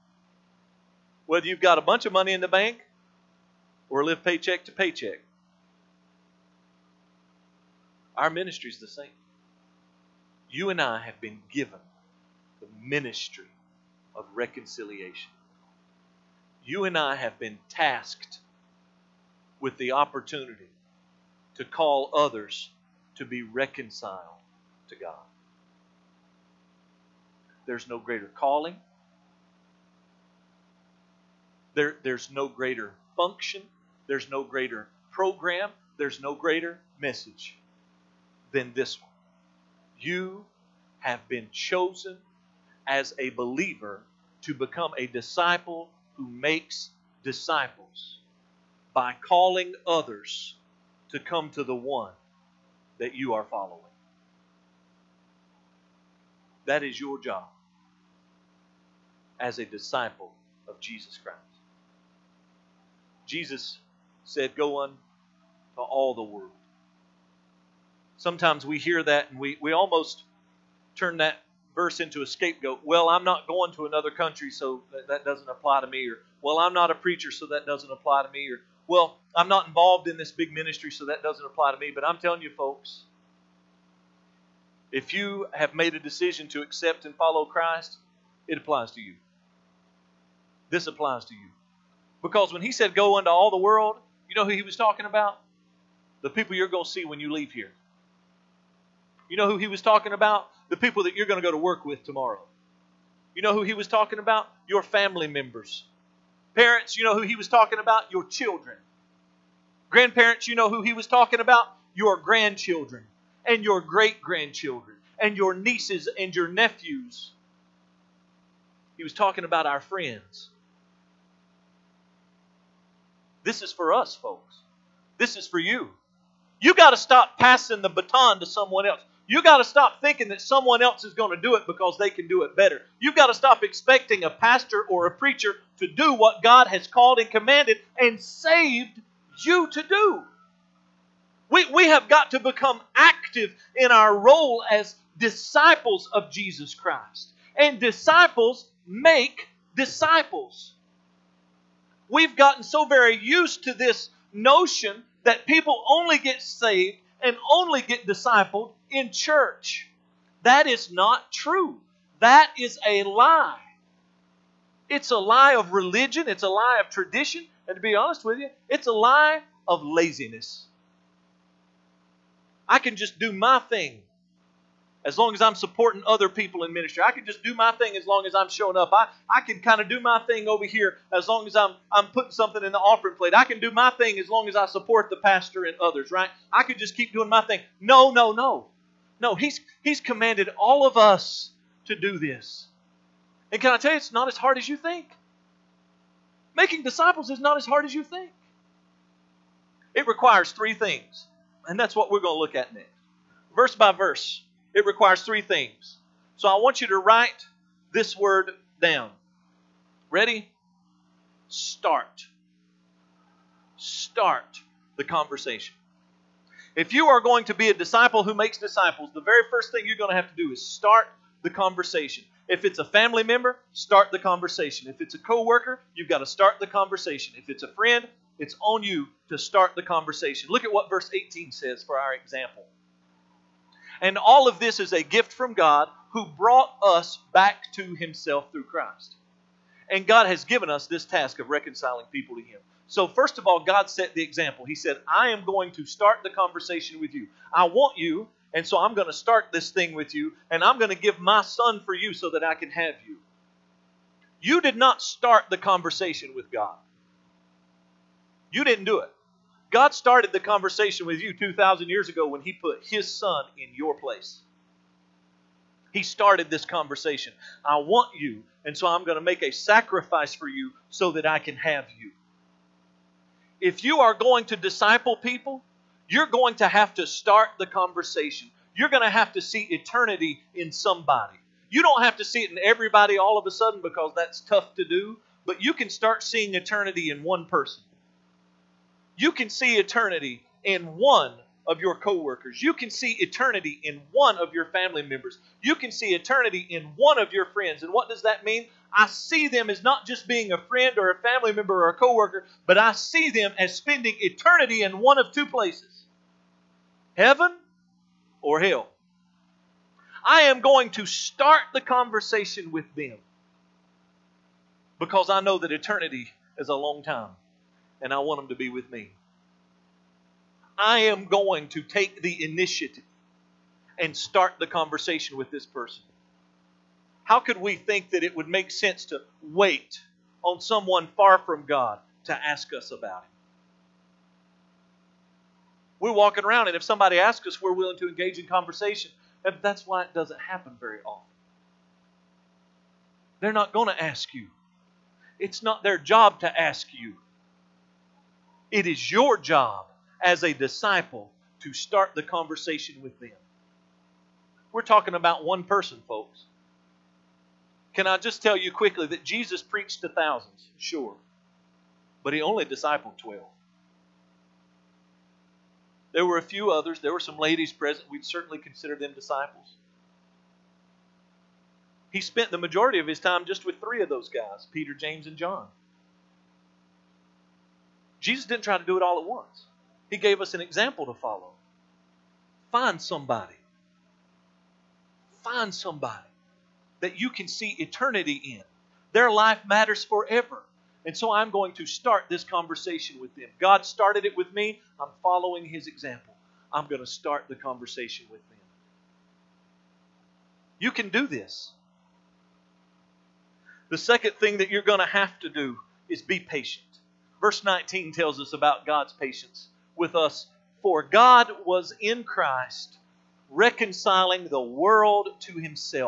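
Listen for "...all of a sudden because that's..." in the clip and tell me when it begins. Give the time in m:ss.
4:43.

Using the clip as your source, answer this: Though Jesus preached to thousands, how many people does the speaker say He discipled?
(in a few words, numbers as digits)
12.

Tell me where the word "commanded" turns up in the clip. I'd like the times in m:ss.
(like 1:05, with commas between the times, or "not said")
2:17, 3:09.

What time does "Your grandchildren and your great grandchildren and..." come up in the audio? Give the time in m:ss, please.
1:51.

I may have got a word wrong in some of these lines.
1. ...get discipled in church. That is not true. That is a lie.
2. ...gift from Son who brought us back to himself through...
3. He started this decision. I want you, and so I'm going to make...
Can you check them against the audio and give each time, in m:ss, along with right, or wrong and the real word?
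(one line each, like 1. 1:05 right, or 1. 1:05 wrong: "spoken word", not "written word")
1. 2:37 right
2. 3:55 wrong: "God", not "Son"
3. 4:25 wrong: "conversation", not "decision".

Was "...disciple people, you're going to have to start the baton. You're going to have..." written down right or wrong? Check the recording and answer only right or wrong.
wrong.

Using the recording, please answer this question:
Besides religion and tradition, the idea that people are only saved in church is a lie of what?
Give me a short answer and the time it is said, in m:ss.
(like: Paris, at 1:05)
Laziness, at 2:49.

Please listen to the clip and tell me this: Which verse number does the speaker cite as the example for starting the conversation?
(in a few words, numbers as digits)
18.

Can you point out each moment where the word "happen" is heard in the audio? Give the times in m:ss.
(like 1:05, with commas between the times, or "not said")
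5:40.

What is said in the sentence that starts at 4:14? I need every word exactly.
You did not start the conversation with God.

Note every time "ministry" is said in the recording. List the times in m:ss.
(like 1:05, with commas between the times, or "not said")
0:08, 0:12, 1:20, 2:56.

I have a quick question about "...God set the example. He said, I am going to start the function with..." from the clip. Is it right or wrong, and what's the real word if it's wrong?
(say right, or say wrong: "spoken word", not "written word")
wrong: "conversation", not "function".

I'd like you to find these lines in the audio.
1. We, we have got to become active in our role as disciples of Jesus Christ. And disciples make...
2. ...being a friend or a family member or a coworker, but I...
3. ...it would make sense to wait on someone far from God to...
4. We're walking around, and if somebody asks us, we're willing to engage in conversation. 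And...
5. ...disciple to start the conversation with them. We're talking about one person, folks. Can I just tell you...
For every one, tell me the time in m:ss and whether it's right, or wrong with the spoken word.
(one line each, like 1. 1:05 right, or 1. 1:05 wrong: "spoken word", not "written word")
1. 2:21 right
2. 5:00 right
3. 5:28 right
4. 5:35 right
5. 5:50 right.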